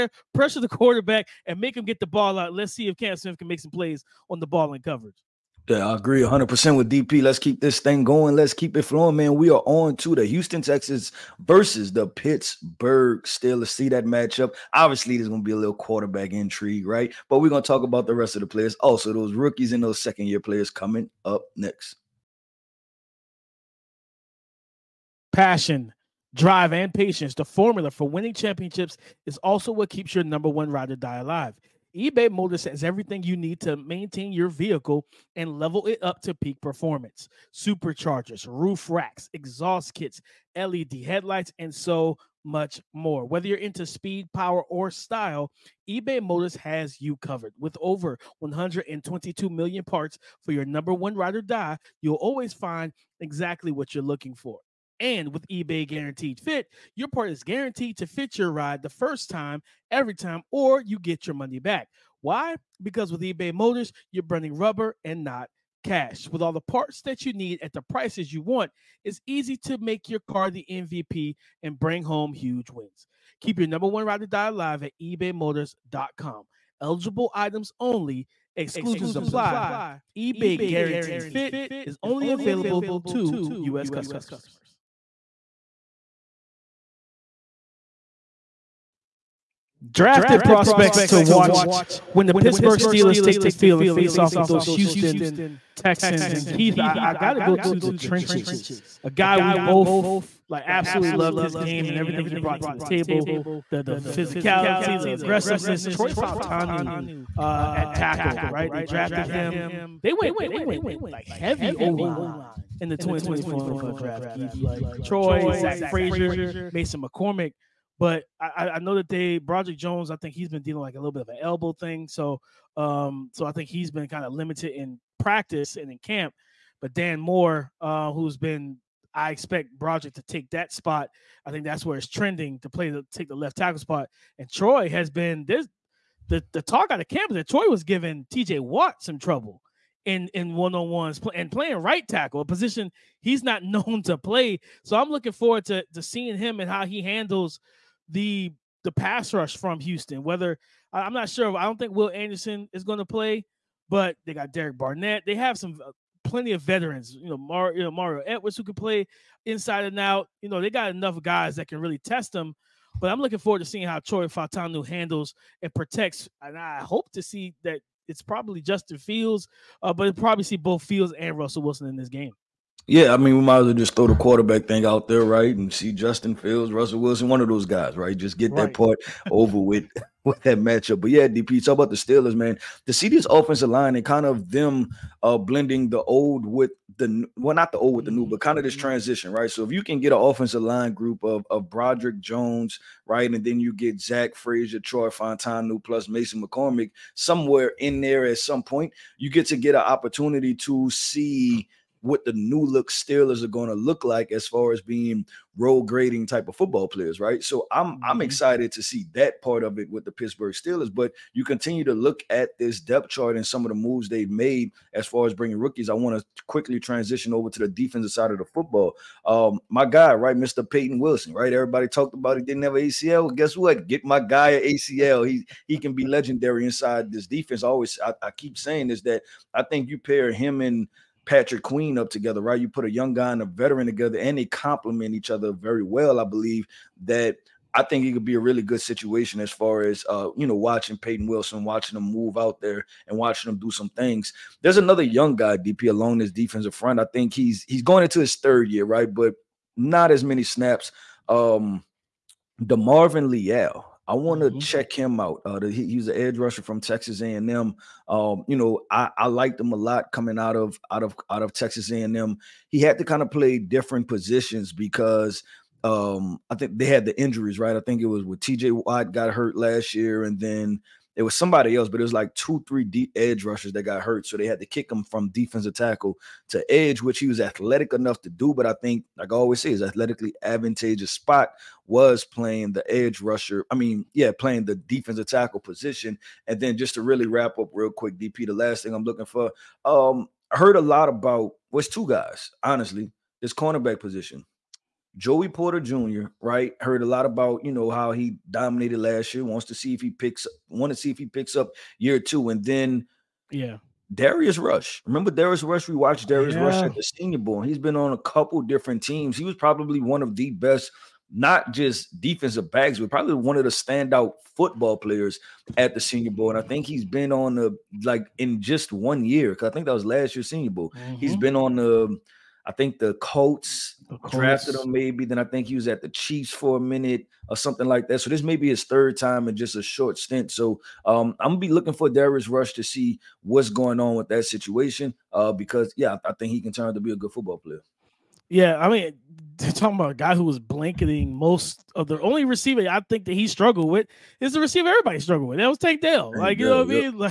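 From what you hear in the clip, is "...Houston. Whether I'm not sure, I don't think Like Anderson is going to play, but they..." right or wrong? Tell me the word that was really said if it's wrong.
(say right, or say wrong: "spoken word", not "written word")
wrong: "Will", not "Like".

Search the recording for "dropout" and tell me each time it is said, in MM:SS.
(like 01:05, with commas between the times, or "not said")
not said.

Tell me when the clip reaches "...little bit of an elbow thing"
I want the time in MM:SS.
02:00.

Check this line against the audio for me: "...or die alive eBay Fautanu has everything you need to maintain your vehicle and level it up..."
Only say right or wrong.
wrong.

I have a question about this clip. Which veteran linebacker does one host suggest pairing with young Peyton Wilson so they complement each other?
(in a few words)
Patrick Queen.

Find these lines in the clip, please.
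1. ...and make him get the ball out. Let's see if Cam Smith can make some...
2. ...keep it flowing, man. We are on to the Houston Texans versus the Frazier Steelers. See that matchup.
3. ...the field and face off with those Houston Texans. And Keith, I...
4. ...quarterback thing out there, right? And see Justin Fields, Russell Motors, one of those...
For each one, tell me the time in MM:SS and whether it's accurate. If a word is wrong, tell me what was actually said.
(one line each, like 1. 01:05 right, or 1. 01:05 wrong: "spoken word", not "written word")
1. 00:01 right
2. 00:08 wrong: "Pittsburgh", not "Frazier"
3. 01:33 right
4. 02:54 wrong: "Wilson", not "Motors".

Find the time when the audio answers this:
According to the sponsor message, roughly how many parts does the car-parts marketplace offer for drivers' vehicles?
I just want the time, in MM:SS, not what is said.
00:48.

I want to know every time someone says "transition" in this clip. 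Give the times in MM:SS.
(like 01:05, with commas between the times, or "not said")
03:08, 03:36.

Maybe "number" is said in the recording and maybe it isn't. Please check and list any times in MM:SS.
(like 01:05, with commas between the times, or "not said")
00:30, 00:50, 01:13.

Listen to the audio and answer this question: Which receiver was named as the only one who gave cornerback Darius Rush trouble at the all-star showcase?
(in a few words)
Tank Dell.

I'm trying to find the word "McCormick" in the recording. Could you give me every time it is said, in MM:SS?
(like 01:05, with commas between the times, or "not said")
01:57, 03:16.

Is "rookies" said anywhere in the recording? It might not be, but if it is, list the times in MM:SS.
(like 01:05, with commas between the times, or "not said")
00:19, 03:35.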